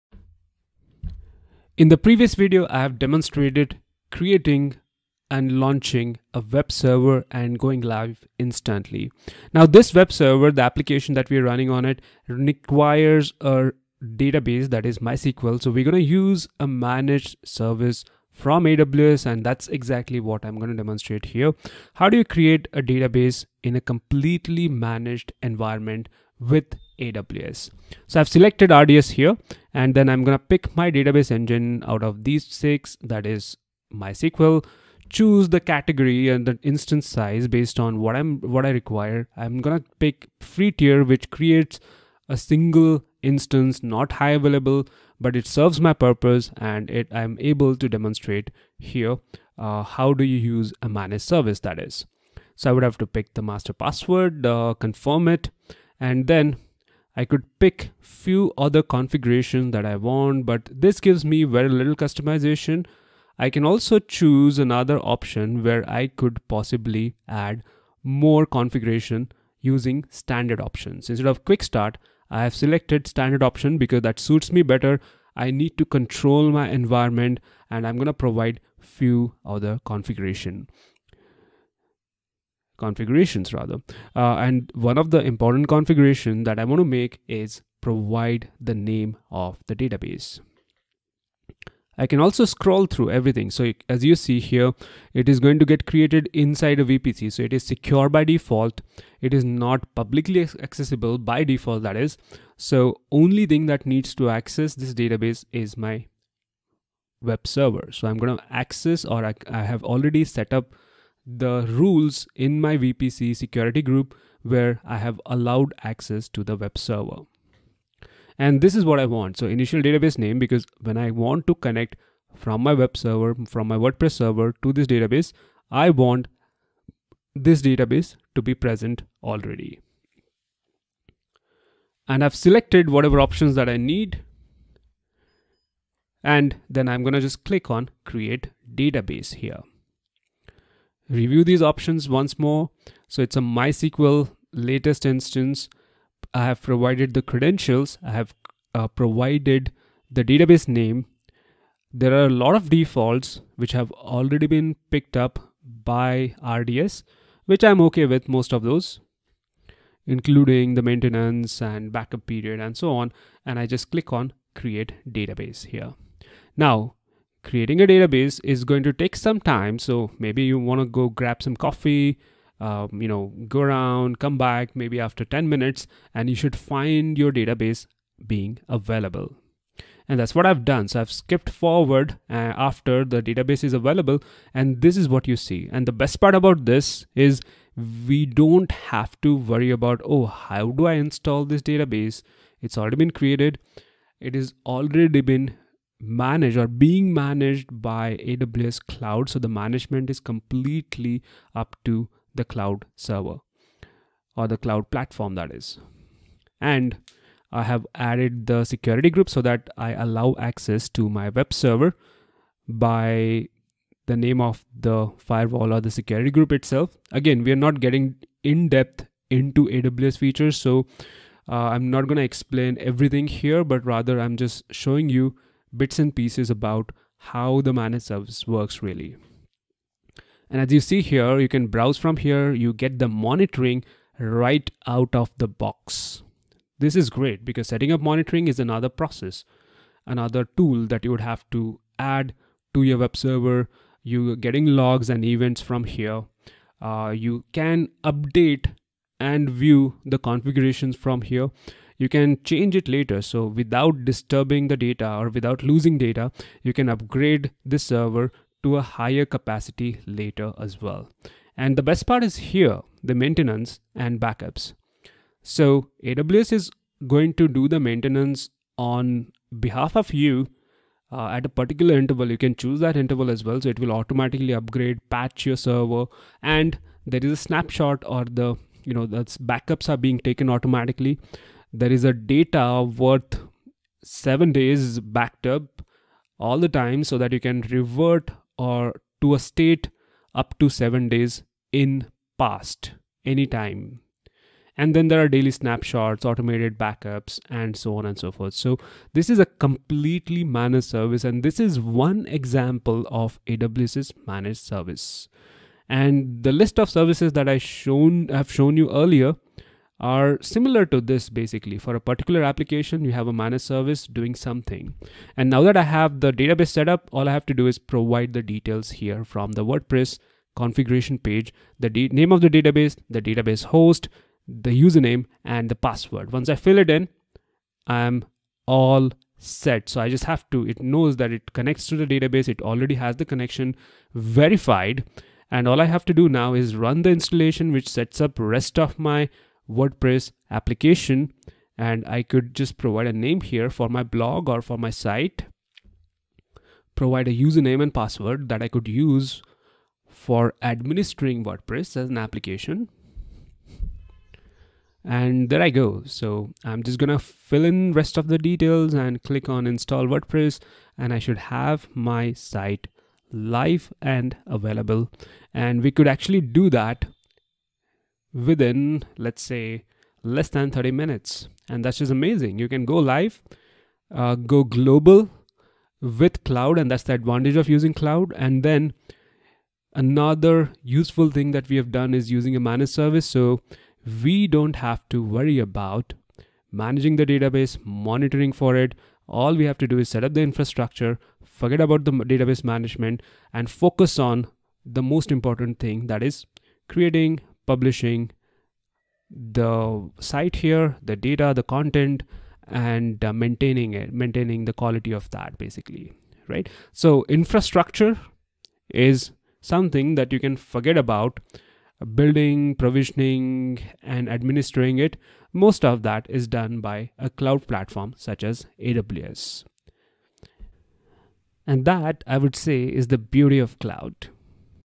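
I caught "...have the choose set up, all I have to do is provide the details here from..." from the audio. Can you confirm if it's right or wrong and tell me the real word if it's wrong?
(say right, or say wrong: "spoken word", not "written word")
wrong: "database", not "choose".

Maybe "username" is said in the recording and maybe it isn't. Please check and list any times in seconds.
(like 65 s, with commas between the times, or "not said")
324 s, 347 s.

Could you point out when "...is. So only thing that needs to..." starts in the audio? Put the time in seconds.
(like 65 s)
102 s.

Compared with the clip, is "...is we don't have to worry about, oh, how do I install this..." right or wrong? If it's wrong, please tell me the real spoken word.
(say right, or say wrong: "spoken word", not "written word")
right.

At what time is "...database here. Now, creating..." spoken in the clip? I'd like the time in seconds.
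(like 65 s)
165 s.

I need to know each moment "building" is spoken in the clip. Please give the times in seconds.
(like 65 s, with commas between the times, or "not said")
412 s.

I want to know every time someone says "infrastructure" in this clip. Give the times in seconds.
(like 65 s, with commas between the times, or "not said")
390 s, 407 s.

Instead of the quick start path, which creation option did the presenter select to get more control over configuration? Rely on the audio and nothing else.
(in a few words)
Standard option.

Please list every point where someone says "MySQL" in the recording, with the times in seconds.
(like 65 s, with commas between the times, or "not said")
14 s, 33 s, 143 s.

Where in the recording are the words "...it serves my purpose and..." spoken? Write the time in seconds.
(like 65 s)
45 s.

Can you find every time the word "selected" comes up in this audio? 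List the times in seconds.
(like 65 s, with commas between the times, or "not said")
28 s, 72 s, 132 s.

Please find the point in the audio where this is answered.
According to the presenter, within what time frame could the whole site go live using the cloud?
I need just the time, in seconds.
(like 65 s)
370 s.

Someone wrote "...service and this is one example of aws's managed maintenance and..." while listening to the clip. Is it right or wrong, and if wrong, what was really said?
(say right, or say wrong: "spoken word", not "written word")
wrong: "service", not "maintenance".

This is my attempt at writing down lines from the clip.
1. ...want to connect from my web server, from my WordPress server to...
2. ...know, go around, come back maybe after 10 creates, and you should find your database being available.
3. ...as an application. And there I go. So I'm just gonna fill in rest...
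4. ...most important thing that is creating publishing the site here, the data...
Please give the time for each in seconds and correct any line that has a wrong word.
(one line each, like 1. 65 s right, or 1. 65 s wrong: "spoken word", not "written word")
1. 121 s right
2. 173 s wrong: "minutes", not "creates"
3. 351 s right
4. 395 s right.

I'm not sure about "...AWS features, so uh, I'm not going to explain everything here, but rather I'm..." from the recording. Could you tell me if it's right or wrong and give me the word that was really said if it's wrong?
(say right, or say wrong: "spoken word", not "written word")
right.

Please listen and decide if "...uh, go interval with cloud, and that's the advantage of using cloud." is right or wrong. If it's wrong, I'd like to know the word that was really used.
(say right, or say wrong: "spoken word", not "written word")
wrong: "global", not "interval".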